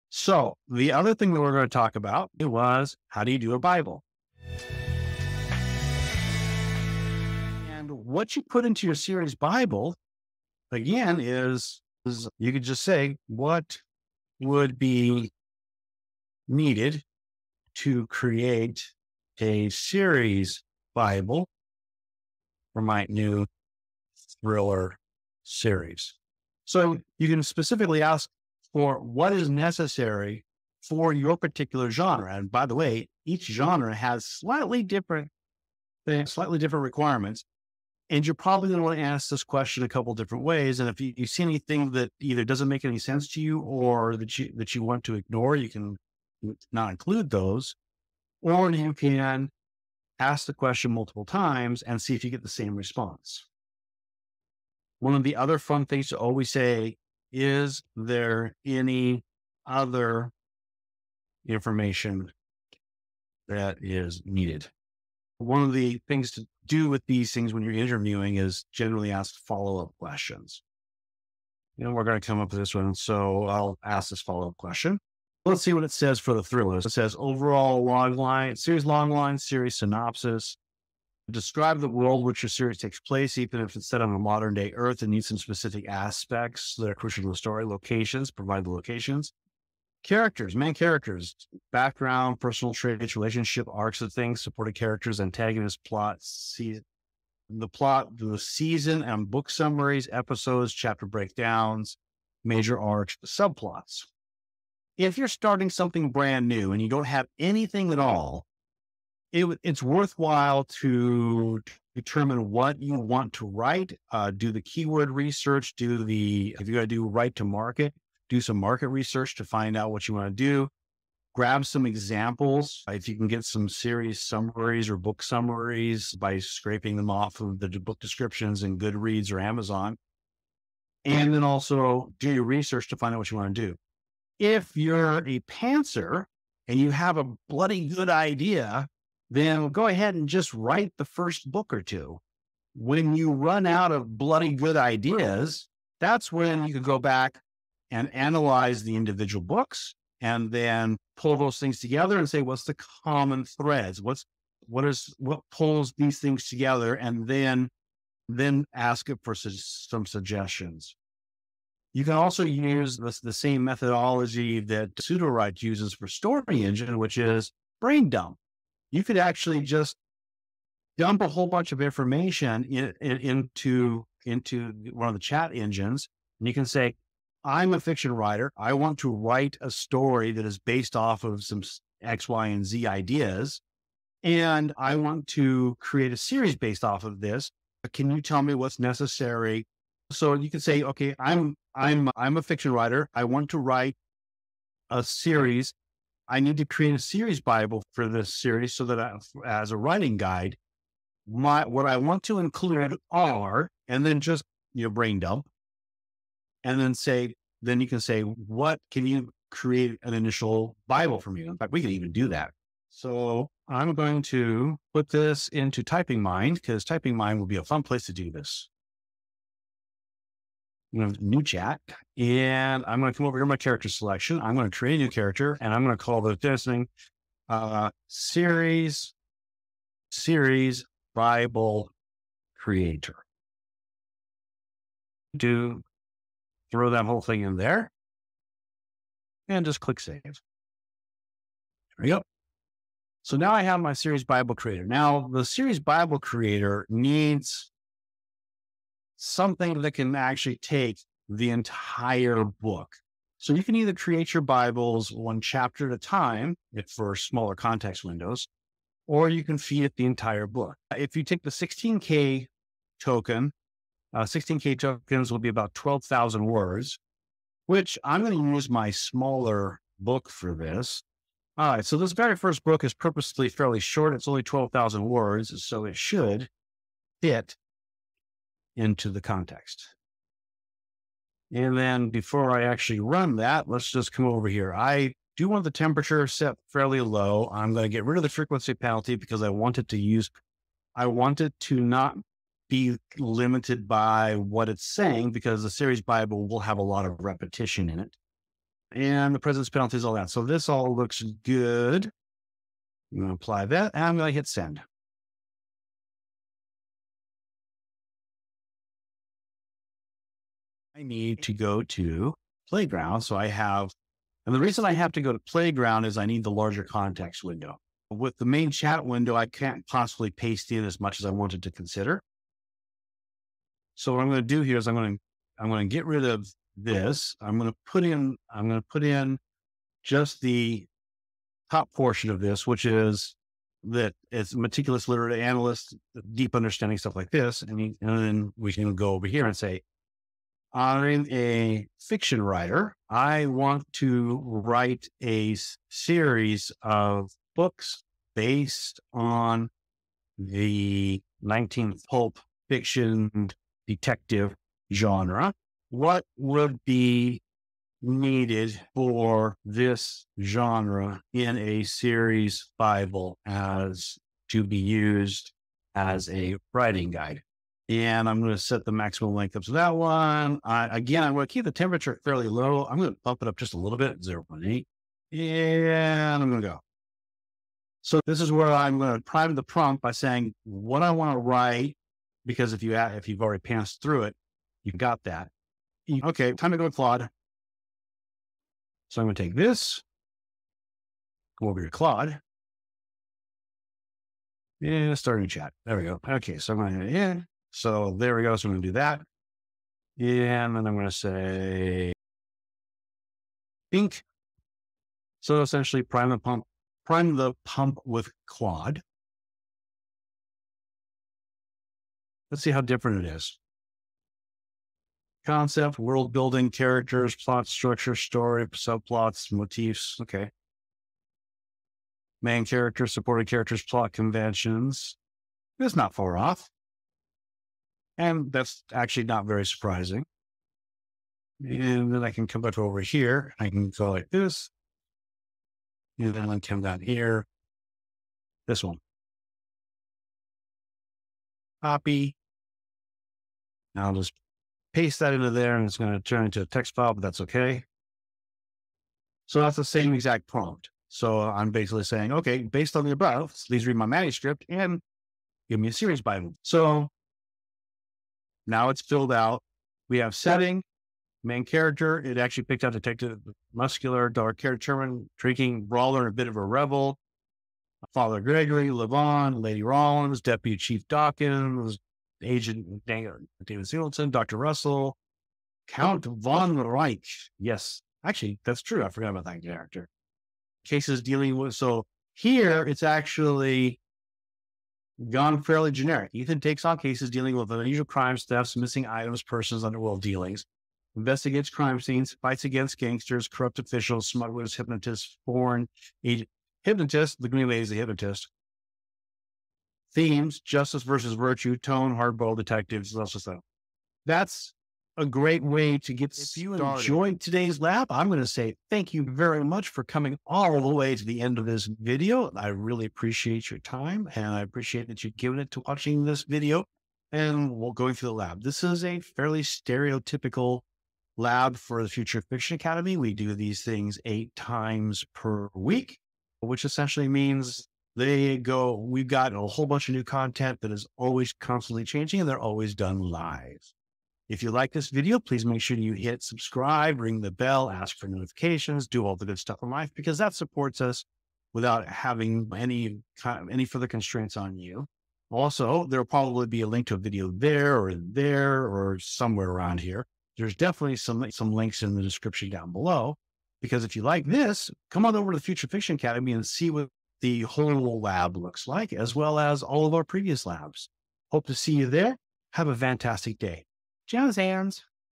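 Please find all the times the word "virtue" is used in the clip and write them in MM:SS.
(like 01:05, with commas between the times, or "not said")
08:21.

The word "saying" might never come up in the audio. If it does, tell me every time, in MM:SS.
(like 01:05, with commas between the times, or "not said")
04:54, 06:20, 07:32.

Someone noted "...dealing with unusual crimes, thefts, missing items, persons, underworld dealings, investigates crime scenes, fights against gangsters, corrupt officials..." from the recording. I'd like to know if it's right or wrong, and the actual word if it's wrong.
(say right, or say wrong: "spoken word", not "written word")
right.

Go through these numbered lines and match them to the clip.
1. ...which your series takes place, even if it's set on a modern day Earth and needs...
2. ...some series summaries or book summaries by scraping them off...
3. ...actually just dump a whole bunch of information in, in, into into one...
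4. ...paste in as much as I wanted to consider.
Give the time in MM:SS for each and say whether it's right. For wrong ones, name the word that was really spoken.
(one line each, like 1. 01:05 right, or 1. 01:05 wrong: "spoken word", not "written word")
1. 01:22 right
2. 02:03 right
3. 02:49 right
4. 05:20 right.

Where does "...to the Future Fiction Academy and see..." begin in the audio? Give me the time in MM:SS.
09:15.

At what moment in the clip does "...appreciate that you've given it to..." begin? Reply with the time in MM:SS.
08:34.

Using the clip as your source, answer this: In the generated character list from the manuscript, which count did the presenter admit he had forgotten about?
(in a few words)
Count Von Reich.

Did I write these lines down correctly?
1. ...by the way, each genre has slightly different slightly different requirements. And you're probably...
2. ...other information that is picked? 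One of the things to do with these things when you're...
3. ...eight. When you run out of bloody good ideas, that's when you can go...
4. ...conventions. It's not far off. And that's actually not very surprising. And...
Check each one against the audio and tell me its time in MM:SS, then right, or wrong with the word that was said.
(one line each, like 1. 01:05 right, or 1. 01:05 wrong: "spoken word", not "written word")
1. 00:32 right
2. 00:59 wrong: "needed", not "picked"
3. 02:21 wrong: "two", not "eight"
4. 07:04 right.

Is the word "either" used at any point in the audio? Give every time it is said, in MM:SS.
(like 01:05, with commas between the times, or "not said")
00:42, 04:13.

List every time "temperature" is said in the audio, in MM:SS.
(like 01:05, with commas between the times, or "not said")
04:45, 06:11.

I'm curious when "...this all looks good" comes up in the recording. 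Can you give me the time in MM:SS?
05:00.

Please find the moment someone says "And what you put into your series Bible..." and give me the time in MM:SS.
00:07.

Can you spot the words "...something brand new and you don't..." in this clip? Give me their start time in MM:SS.
01:45.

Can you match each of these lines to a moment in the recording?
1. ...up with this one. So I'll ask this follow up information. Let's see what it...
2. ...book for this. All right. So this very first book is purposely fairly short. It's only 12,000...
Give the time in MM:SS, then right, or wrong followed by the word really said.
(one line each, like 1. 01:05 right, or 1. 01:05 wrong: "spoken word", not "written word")
1. 01:12 wrong: "question", not "information"
2. 04:29 right.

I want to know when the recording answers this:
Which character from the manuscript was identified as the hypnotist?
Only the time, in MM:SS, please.
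08:17.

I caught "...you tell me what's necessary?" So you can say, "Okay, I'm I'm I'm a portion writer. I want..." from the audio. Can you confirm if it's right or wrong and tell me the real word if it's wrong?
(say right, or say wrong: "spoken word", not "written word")
wrong: "fiction", not "portion".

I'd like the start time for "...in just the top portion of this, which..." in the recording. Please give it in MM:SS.
05:29.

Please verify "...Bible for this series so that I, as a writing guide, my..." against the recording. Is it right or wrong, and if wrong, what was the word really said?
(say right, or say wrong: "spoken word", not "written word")
right.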